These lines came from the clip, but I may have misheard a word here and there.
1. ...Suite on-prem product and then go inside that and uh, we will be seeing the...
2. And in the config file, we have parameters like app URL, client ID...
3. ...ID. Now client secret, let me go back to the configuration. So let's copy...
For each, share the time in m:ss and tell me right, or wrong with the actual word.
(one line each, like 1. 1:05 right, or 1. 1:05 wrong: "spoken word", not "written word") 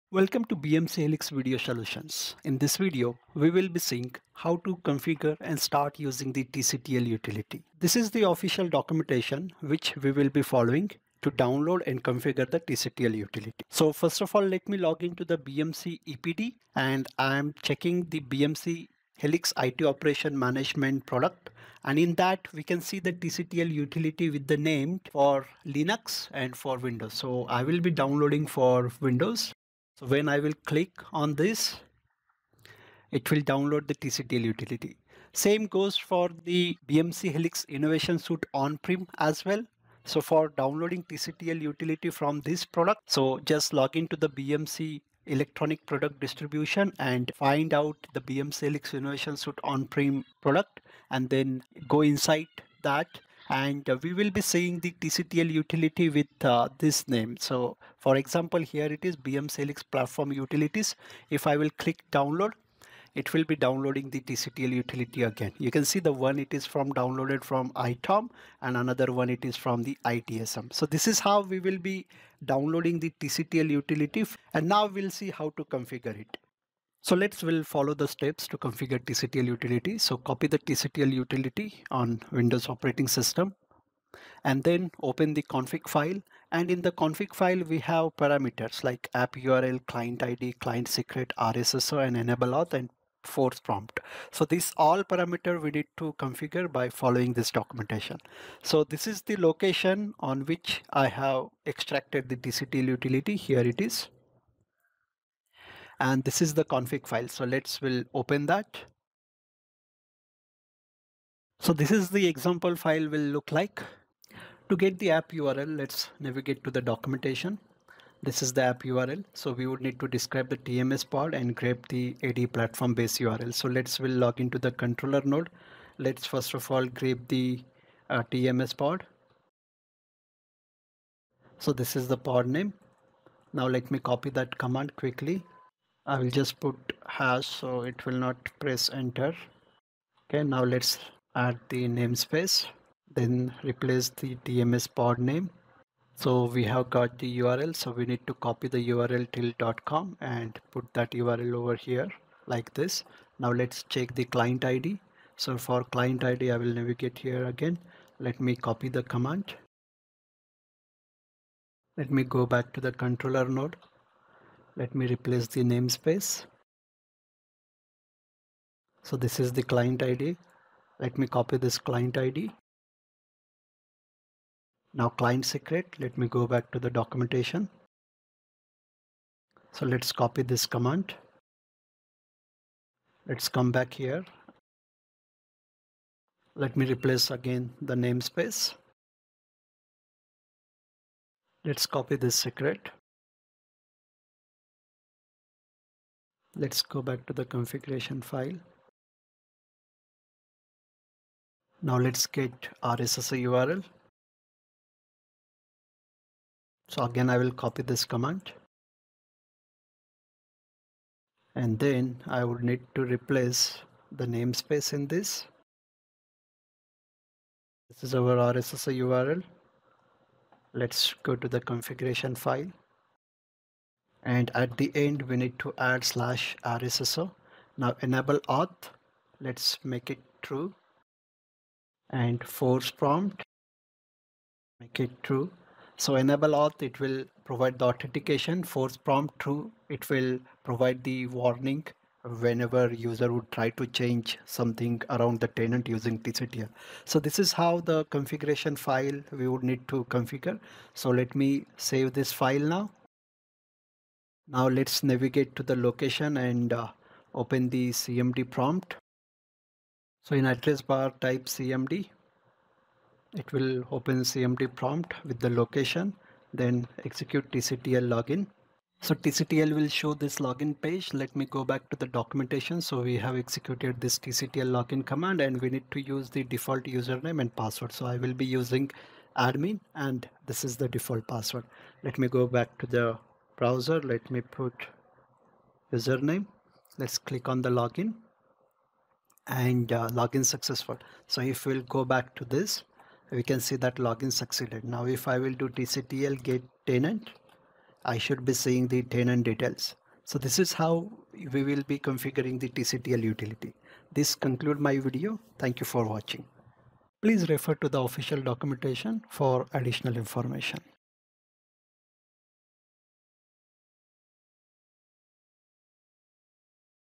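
1. 0:49 right
2. 1:26 right
3. 2:52 wrong: "documentation", not "configuration".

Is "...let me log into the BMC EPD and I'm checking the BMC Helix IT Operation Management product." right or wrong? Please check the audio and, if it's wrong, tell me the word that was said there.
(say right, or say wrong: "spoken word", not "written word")
right.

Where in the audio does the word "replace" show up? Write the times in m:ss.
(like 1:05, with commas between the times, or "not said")
2:23, 2:45, 3:06, 3:33.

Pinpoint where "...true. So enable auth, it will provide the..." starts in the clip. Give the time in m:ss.
3:55.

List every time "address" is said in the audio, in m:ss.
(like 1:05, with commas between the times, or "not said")
4:20.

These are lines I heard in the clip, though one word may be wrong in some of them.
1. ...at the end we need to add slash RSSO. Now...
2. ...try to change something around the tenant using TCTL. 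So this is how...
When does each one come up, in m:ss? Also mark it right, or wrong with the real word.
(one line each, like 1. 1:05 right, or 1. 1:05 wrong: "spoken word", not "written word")
1. 3:44 right
2. 4:03 right.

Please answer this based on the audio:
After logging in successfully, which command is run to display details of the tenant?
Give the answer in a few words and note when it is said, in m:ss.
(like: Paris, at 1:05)
tctl get tenant, at 4:55.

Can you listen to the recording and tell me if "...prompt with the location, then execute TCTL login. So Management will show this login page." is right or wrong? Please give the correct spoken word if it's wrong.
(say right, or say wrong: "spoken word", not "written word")
wrong: "TCTL", not "Management".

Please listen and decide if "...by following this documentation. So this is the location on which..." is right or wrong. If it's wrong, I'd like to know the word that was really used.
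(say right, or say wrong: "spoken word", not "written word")
right.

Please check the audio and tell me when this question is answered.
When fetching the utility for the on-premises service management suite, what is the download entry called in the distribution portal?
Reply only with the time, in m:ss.
0:59.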